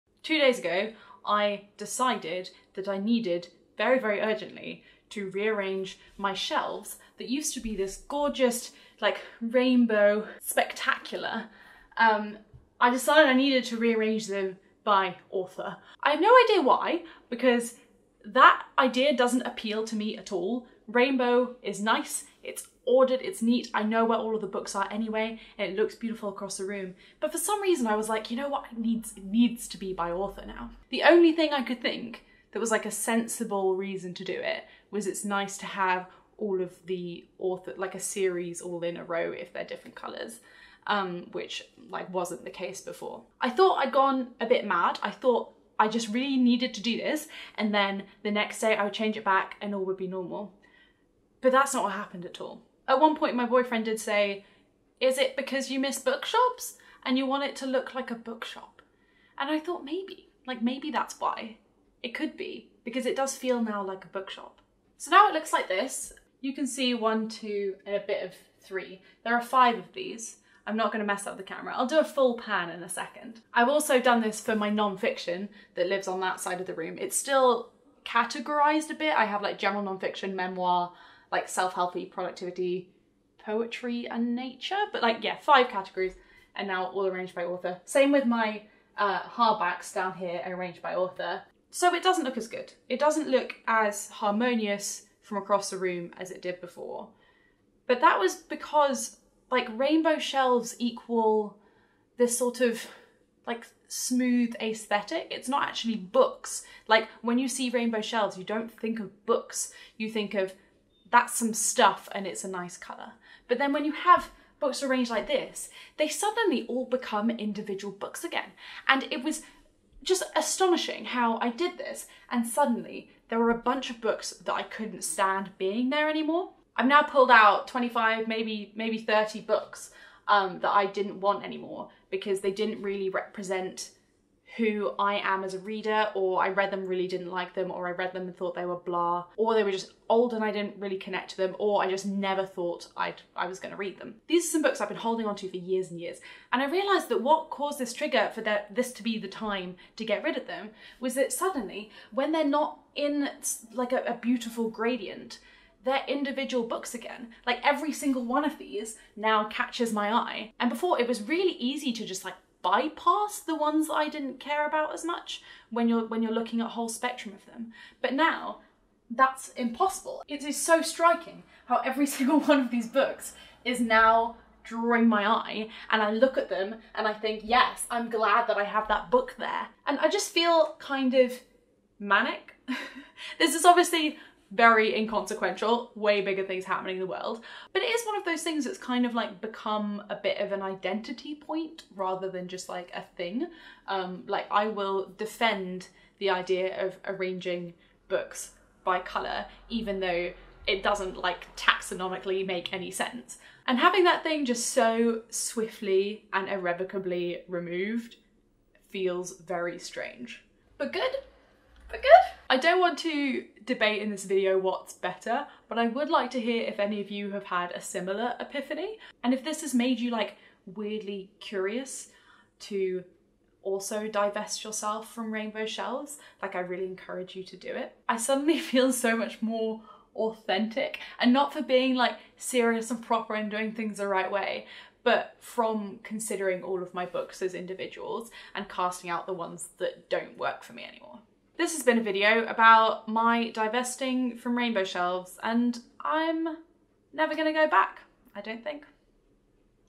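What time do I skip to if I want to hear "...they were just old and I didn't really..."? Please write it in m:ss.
2:19.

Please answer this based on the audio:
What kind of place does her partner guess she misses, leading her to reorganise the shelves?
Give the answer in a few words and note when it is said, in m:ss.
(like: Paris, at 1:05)
Bookshops, at 0:55.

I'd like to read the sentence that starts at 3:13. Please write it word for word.
Um, like I will defend the idea of arranging books by color, even though it doesn't like taxonomically make any sense.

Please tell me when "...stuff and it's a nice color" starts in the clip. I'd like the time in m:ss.
1:51.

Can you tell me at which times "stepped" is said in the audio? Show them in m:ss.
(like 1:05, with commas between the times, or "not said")
not said.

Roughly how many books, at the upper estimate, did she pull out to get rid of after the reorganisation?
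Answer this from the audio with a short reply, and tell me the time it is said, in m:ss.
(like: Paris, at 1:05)
30, at 2:08.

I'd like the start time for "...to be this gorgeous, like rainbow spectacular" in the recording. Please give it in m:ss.
0:07.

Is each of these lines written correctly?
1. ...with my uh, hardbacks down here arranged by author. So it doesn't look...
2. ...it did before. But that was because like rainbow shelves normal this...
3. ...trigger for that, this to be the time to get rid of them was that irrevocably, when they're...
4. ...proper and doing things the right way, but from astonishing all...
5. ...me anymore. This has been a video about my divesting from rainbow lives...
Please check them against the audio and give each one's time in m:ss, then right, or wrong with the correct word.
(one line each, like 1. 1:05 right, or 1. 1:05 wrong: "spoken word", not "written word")
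1. 1:28 right
2. 1:36 wrong: "equal", not "normal"
3. 2:27 wrong: "suddenly", not "irrevocably"
4. 3:53 wrong: "considering", not "astonishing"
5. 4:00 wrong: "shelves", not "lives".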